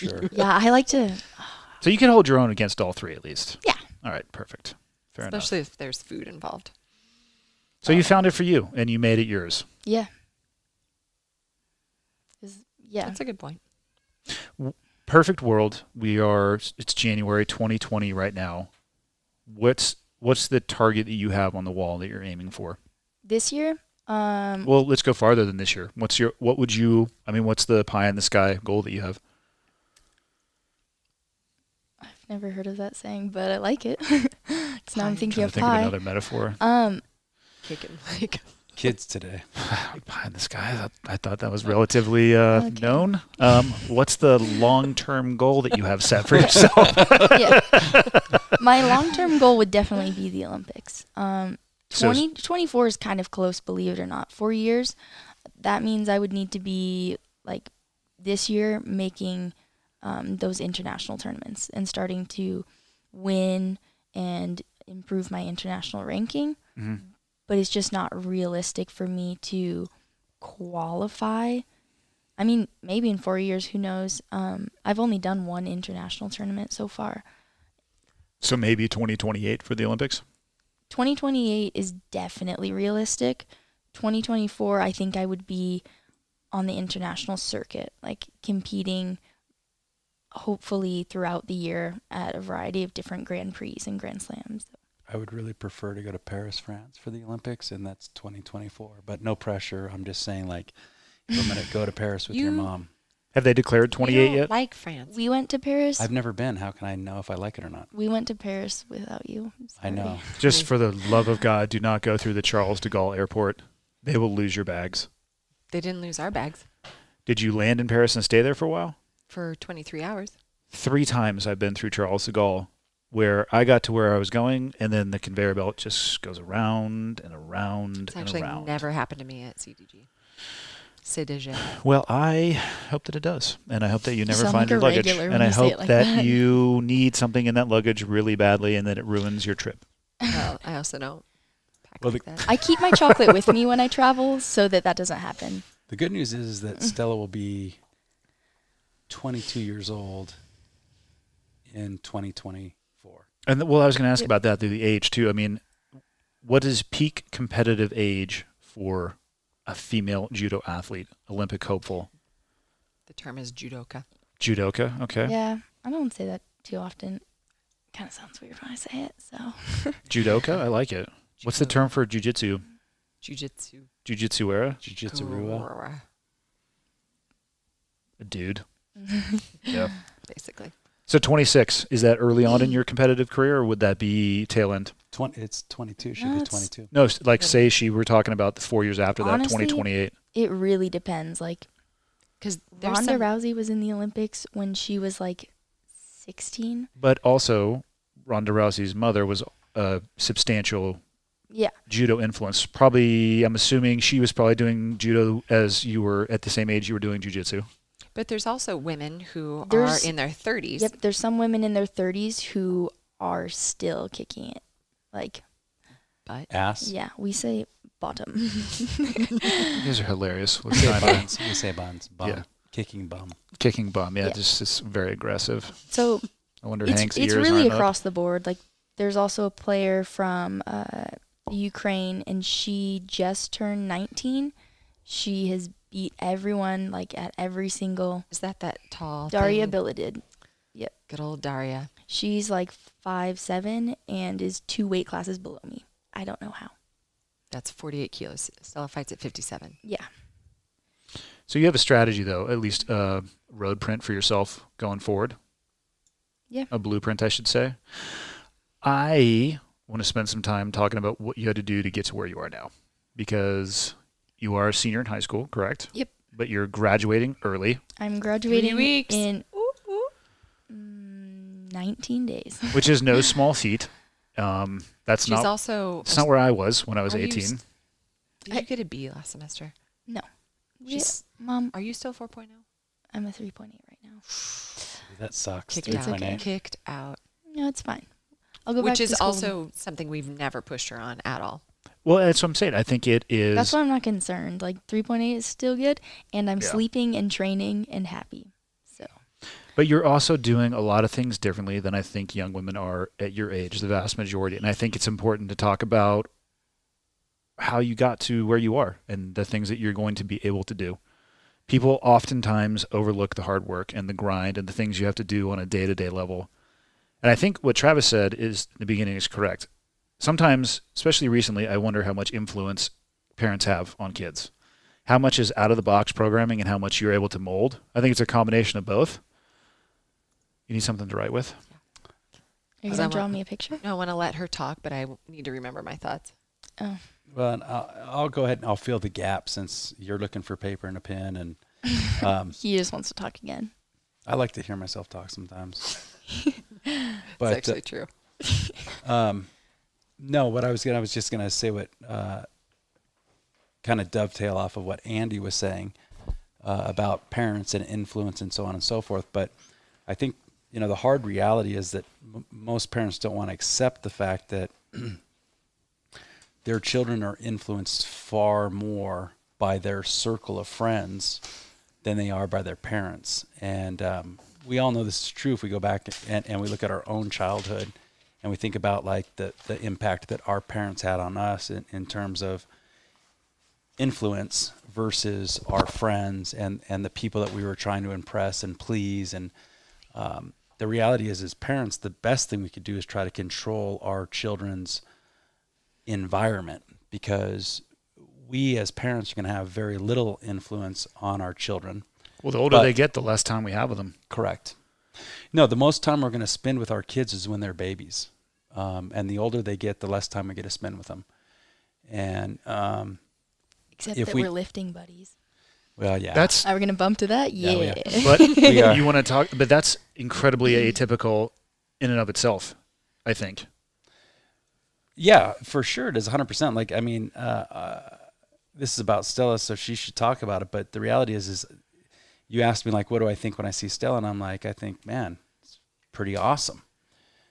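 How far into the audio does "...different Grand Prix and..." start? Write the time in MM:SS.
01:32.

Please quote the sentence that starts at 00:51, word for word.
Um, 20, 24 is kind of close, believe it or not.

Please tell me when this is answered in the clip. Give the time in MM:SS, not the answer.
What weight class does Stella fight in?
04:09.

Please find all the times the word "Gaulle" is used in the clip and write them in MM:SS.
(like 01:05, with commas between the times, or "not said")
01:52, 02:02.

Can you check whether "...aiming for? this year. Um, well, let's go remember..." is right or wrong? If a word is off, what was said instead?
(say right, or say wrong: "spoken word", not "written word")
wrong: "farther", not "remember".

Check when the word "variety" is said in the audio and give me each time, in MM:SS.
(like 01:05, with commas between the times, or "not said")
01:32.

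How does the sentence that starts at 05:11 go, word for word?
People oftentimes overlook the hard work and the grind and the things you have to do on a day to day level.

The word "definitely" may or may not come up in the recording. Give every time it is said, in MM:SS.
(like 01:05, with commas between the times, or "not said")
00:49, 01:22.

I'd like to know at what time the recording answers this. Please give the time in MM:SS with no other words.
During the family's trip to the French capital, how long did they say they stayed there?
01:59.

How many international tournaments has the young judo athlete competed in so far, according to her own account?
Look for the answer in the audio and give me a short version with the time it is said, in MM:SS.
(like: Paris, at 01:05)
1, at 01:15.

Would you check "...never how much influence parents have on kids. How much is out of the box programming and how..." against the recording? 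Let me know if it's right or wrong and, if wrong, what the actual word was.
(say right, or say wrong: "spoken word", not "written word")
wrong: "wonder", not "never".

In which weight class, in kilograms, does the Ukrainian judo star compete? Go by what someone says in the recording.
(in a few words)
48 kilos.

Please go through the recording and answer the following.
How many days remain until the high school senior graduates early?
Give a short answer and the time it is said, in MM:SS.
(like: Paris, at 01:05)
19 days, at 04:31.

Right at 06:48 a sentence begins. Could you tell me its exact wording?
Um, and the older they get, the less time we get to spend with them.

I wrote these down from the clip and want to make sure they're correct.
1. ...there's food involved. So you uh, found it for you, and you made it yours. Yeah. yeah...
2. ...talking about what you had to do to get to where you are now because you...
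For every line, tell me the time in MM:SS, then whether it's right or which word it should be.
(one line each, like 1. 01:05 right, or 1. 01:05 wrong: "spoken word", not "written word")
1. 00:05 right
2. 04:20 right.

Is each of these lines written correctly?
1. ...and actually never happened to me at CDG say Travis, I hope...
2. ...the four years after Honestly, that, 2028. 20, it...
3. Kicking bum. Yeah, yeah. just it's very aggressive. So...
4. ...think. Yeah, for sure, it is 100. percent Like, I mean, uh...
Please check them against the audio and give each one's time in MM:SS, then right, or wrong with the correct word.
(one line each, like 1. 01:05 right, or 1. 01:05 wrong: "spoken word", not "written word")
1. 02:08 wrong: "Well", not "Travis"
2. 03:08 right
3. 03:43 right
4. 07:03 right.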